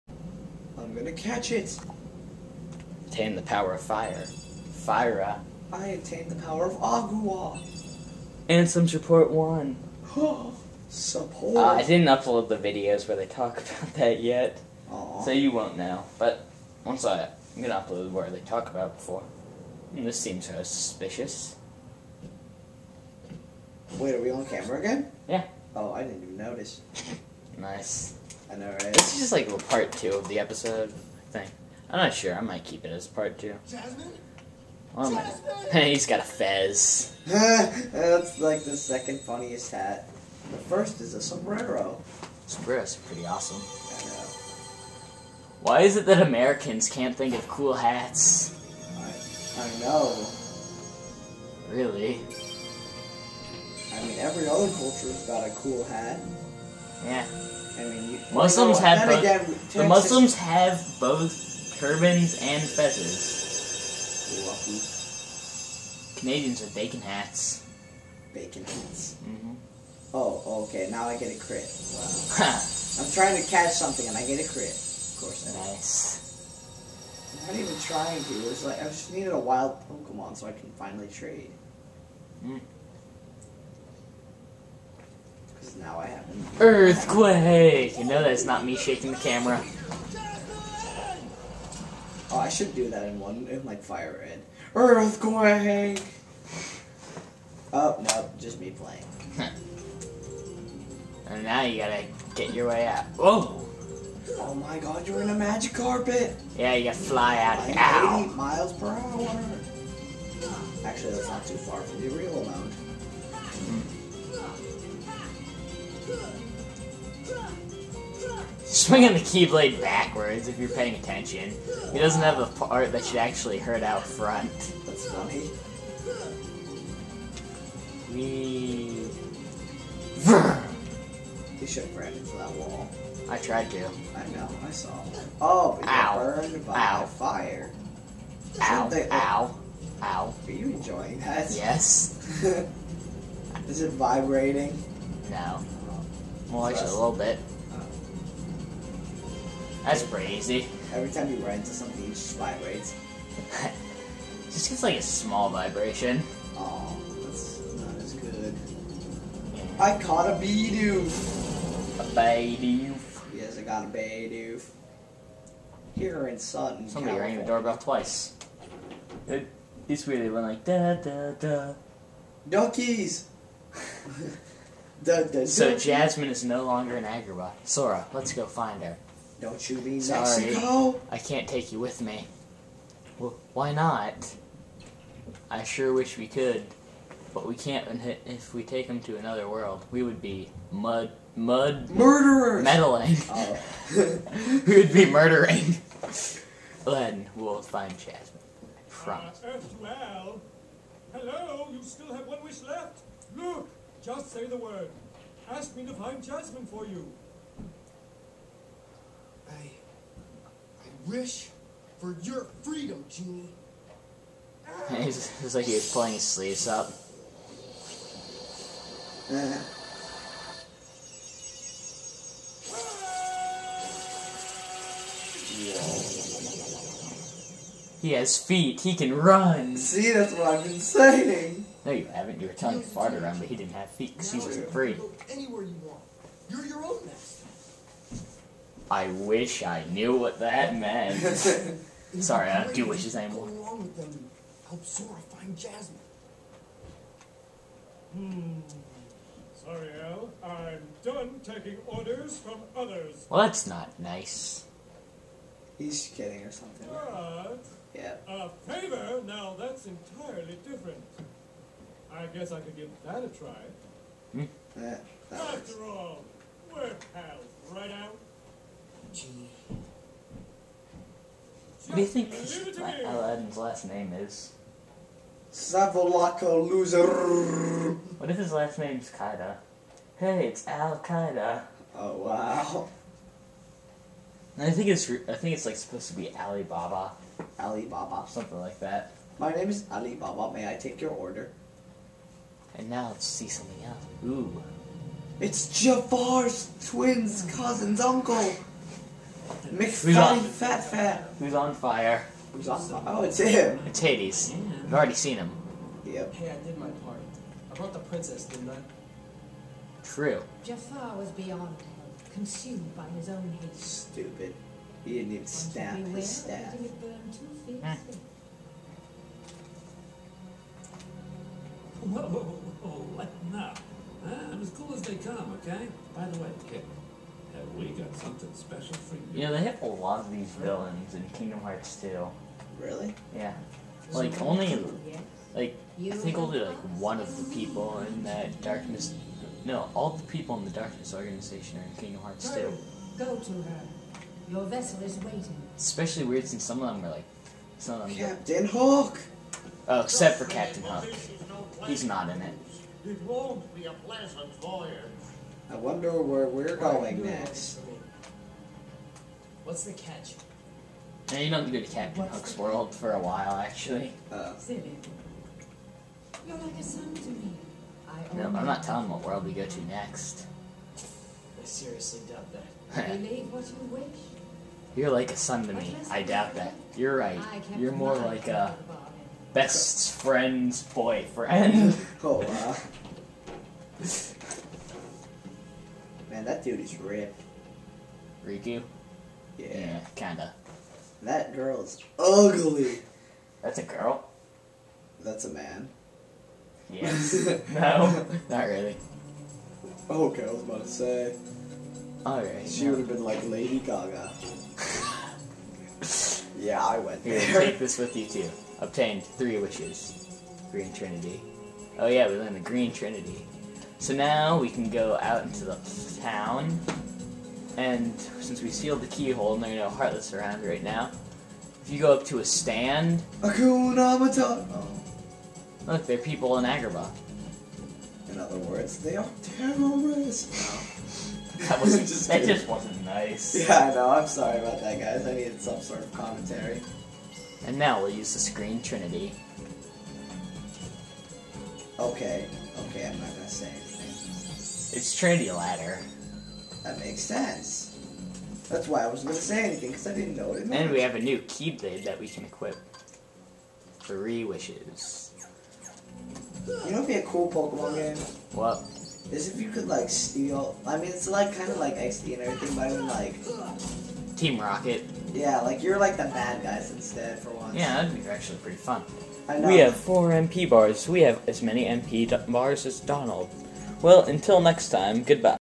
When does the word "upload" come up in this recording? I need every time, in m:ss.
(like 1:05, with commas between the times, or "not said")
0:12, 0:17.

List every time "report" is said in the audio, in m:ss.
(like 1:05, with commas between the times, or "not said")
0:08.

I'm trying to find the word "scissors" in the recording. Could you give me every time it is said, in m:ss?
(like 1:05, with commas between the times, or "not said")
not said.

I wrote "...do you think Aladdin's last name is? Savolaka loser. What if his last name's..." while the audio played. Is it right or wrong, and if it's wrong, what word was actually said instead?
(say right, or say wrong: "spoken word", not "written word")
right.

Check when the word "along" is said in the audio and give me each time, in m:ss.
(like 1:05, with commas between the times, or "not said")
4:03.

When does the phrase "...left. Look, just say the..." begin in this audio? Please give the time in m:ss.
3:22.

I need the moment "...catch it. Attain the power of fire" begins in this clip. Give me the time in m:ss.
0:01.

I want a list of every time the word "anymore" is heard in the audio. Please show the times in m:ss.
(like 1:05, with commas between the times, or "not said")
4:03.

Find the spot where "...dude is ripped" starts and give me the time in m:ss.
6:26.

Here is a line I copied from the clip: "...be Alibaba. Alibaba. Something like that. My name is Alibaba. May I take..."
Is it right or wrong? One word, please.
right.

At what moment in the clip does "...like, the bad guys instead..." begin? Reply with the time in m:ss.
7:45.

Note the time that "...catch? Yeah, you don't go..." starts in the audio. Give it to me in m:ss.
5:59.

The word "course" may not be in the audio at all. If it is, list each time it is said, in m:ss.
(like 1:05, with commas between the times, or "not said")
1:15.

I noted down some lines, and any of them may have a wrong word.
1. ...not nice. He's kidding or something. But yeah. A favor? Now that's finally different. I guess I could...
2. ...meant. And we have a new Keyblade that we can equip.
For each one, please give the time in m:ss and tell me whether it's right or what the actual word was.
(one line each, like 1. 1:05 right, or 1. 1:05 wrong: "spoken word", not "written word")
1. 4:13 wrong: "entirely", not "finally"
2. 7:30 right.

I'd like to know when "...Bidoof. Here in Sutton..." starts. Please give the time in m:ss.
2:43.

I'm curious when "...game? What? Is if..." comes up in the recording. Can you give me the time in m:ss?
7:37.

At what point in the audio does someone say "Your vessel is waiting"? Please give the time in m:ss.
5:44.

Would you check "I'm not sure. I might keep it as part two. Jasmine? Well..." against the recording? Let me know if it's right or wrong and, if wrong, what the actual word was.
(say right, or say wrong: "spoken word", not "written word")
right.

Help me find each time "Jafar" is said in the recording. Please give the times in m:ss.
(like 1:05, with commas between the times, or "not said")
4:55, 5:10.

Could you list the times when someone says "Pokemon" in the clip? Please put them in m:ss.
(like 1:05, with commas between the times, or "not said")
1:19, 7:37.